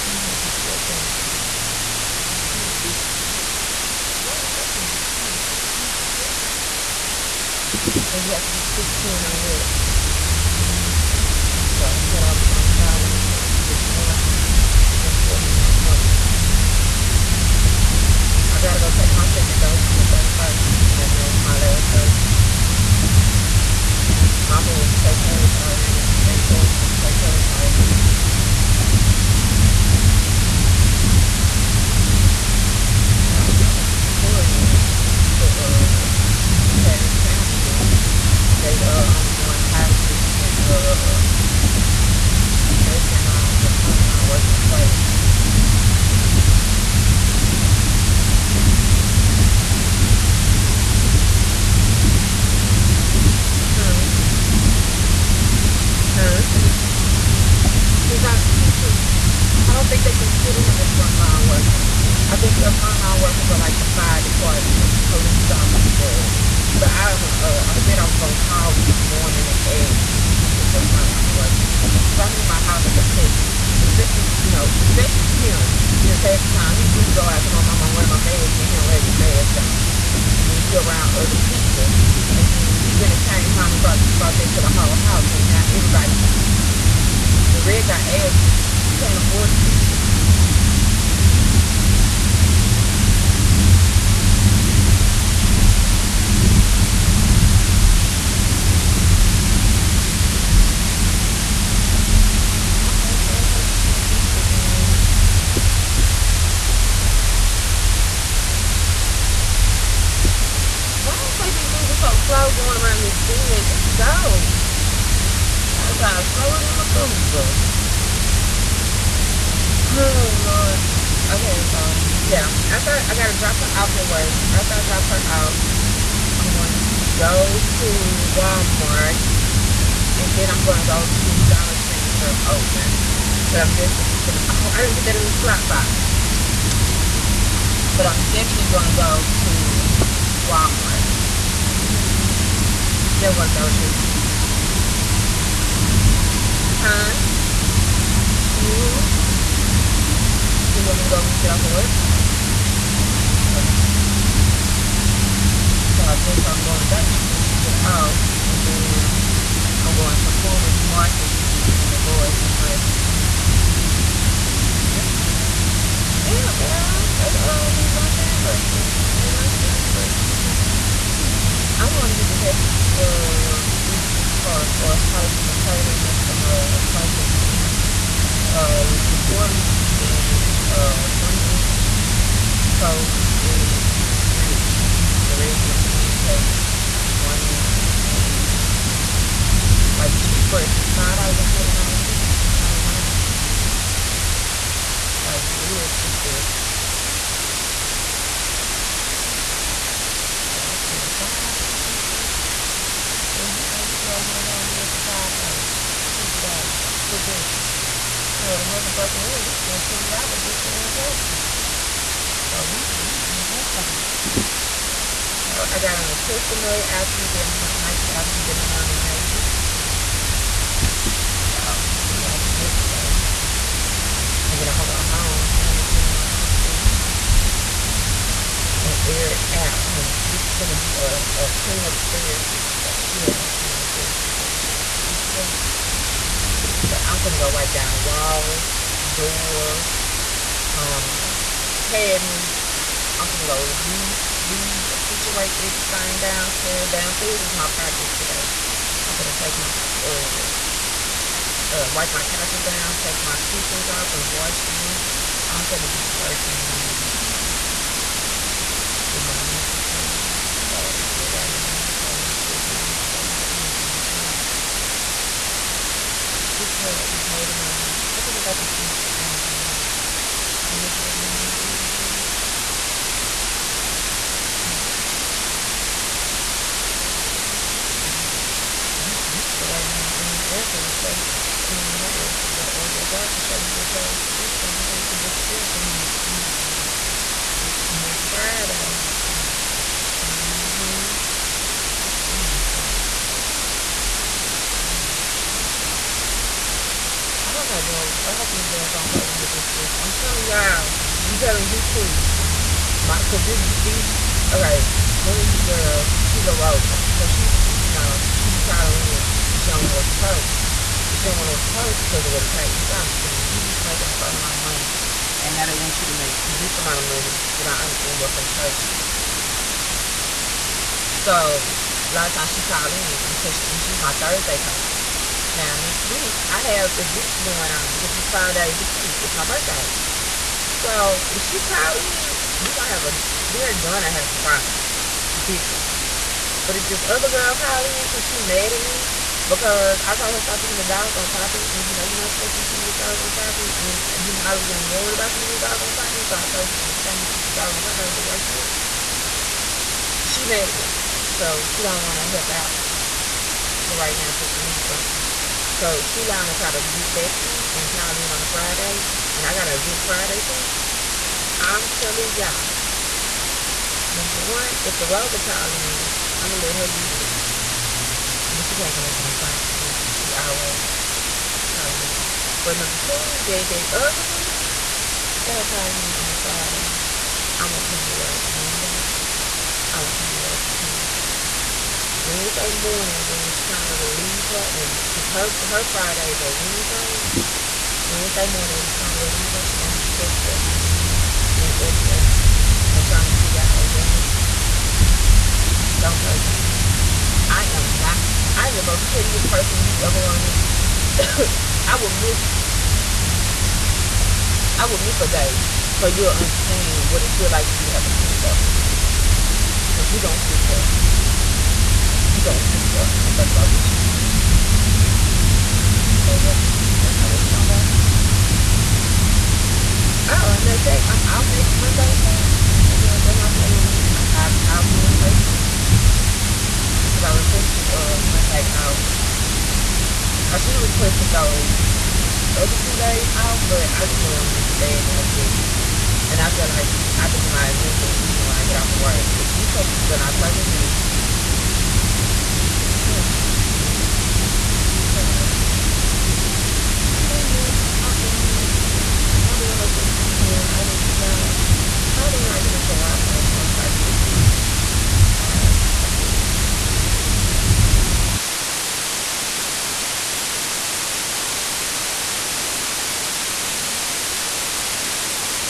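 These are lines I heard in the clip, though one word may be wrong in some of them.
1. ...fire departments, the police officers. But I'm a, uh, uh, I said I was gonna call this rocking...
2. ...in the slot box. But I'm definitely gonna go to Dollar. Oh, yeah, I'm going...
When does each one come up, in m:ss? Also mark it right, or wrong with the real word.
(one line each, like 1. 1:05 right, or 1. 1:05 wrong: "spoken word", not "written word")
1. 1:03 wrong: "morning", not "rocking"
2. 2:15 wrong: "Walmart", not "Dollar".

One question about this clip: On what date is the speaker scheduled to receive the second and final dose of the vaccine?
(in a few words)
the 31st.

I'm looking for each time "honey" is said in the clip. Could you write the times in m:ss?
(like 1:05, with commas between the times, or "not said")
3:49, 4:16.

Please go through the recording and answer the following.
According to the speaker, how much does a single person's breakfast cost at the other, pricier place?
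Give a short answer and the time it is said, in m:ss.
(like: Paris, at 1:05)
$20, at 3:29.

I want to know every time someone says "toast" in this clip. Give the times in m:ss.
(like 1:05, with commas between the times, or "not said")
2:56, 3:02.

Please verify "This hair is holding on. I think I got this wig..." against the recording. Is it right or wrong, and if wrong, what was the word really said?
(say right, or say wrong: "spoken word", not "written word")
right.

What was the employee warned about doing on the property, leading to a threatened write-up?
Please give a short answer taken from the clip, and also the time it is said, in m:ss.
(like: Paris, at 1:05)
feeding the dog, at 5:40.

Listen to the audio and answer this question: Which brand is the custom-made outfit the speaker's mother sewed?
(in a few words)
Nike.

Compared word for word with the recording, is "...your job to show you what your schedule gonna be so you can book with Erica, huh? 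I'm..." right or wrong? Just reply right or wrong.
right.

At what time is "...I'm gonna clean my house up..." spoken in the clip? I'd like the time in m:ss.
3:45.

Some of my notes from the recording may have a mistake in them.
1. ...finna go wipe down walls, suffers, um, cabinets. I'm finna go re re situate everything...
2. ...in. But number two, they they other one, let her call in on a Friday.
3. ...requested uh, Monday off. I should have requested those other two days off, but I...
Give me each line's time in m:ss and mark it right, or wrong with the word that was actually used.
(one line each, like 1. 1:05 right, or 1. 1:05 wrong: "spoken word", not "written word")
1. 3:57 wrong: "doors", not "suffers"
2. 6:12 right
3. 7:07 right.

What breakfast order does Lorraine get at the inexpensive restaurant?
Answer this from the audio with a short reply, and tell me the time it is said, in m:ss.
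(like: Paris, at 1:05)
pancakes, one meat, and eggs, at 3:05.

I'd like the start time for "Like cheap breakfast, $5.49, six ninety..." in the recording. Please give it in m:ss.
3:09.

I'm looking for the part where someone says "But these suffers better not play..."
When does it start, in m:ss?
7:19.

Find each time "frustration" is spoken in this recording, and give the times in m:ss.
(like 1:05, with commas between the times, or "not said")
5:18.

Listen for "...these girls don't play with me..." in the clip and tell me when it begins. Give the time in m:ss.
4:58.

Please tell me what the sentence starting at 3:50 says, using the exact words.
This is gonna be a, a cleanup therapy.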